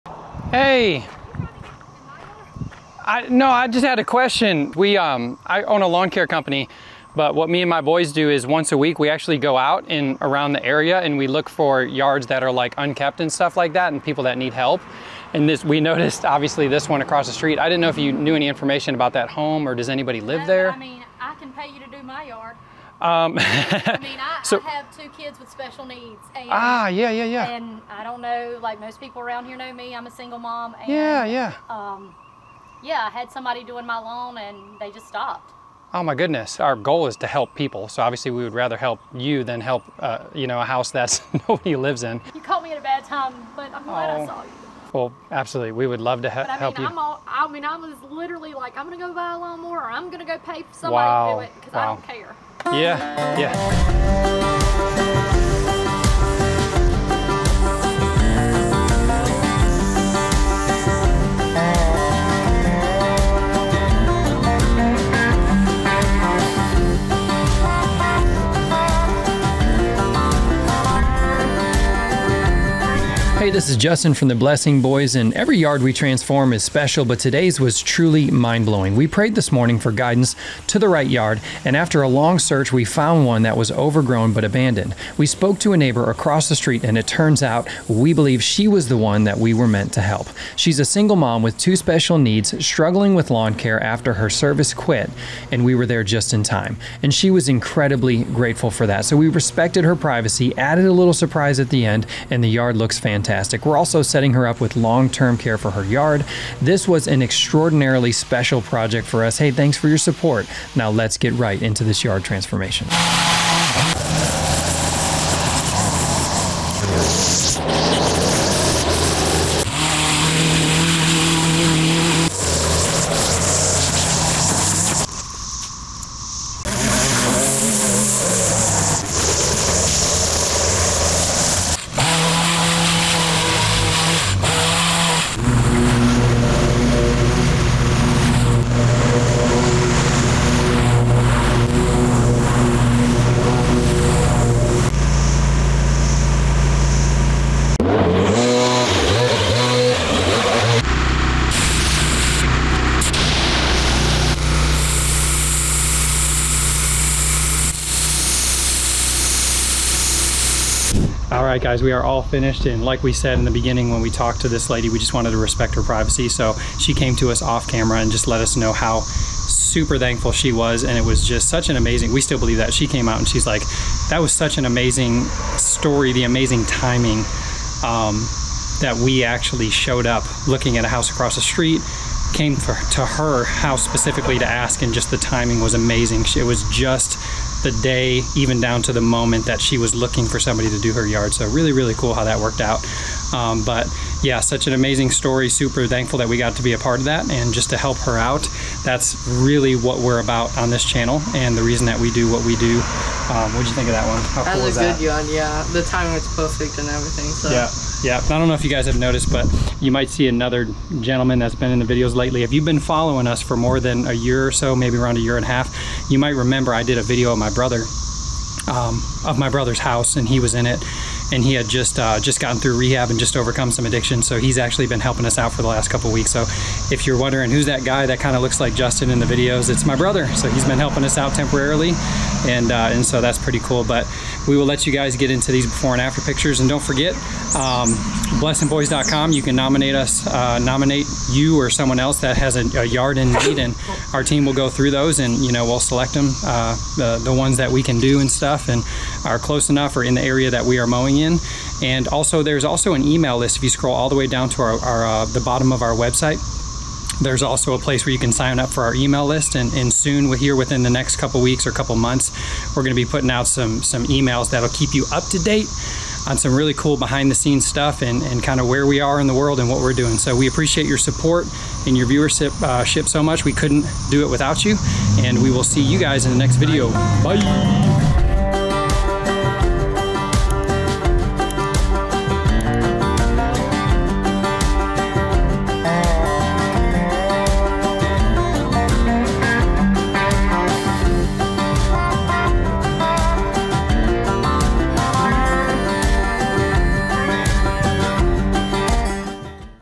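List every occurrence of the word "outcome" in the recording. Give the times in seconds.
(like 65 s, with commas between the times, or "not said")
not said.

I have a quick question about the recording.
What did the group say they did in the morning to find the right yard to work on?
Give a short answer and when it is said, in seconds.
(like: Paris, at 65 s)
Prayed, at 78 s.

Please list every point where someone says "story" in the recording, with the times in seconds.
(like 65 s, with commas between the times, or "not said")
175 s, 195 s.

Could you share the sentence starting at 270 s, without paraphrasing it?
So we appreciate your support and your viewership uh, so much.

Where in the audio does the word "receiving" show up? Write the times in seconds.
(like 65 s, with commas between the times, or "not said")
not said.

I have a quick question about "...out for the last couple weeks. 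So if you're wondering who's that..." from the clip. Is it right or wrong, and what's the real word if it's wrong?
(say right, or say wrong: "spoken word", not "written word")
right.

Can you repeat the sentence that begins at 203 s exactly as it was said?
Um, what'd you think of that one?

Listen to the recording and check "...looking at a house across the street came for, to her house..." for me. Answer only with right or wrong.
right.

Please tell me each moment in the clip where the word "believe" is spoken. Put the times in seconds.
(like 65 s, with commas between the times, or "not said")
88 s, 172 s.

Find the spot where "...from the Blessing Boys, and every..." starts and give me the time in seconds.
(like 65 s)
74 s.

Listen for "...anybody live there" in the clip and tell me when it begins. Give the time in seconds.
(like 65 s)
19 s.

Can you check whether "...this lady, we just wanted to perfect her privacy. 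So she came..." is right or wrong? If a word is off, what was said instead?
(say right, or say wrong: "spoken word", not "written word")
wrong: "respect", not "perfect".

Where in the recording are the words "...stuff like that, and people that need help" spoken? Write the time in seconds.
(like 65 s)
13 s.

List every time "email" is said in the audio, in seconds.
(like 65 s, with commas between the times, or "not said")
253 s, 258 s, 264 s.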